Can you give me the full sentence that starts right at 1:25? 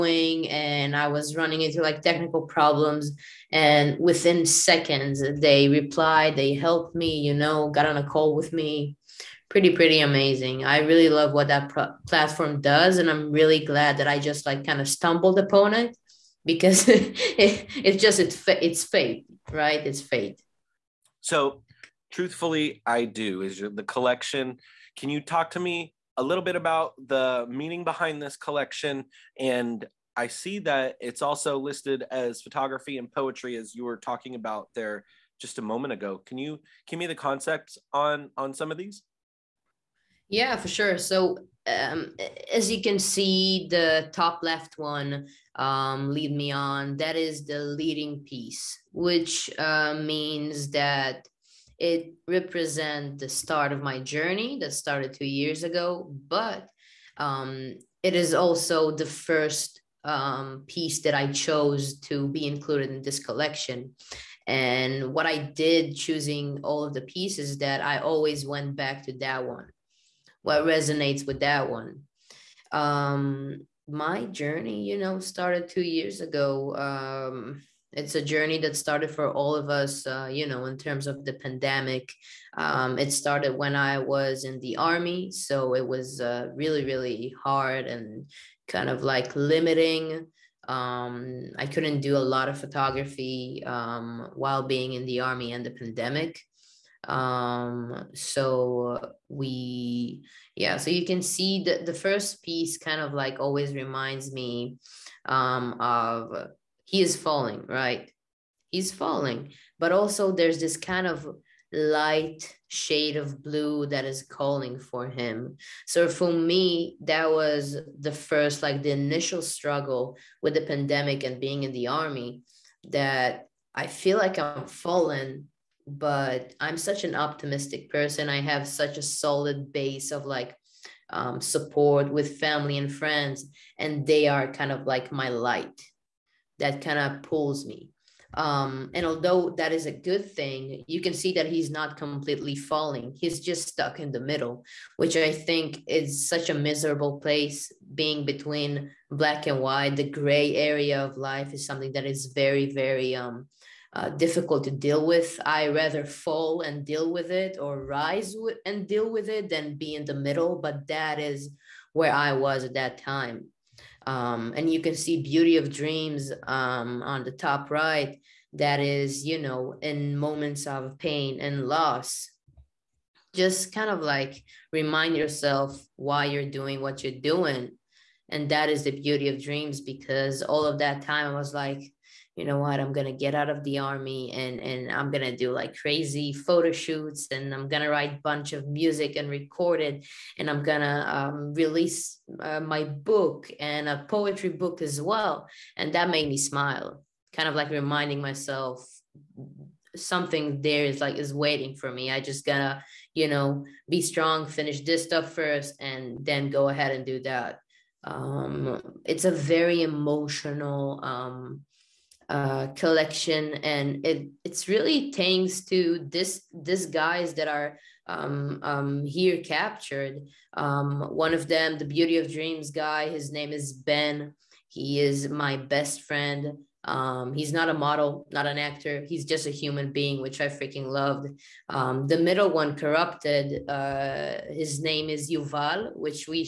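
So it was uh, really, really hard and kind of like limiting.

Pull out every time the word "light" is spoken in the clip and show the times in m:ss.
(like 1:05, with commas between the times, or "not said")
1:51, 2:15.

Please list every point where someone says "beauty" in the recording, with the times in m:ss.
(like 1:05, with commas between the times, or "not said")
2:45, 2:58, 3:41.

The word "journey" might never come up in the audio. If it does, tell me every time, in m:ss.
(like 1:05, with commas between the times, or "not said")
0:54, 1:14, 1:18.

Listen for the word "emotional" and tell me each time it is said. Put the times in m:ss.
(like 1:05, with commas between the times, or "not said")
3:29.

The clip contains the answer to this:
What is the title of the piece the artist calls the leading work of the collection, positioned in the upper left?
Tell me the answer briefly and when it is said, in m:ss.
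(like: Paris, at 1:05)
Lead Me On, at 0:46.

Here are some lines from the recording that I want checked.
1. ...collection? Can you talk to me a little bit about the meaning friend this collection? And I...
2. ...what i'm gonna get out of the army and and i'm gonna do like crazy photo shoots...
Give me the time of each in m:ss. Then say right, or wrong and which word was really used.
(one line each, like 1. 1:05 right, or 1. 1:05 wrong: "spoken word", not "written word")
1. 0:23 wrong: "behind", not "friend"
2. 3:02 right.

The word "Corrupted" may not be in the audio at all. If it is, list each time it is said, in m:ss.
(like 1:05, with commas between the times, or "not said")
3:52.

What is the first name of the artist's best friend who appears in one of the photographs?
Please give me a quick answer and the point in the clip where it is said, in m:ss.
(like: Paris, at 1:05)
Ben, at 3:43.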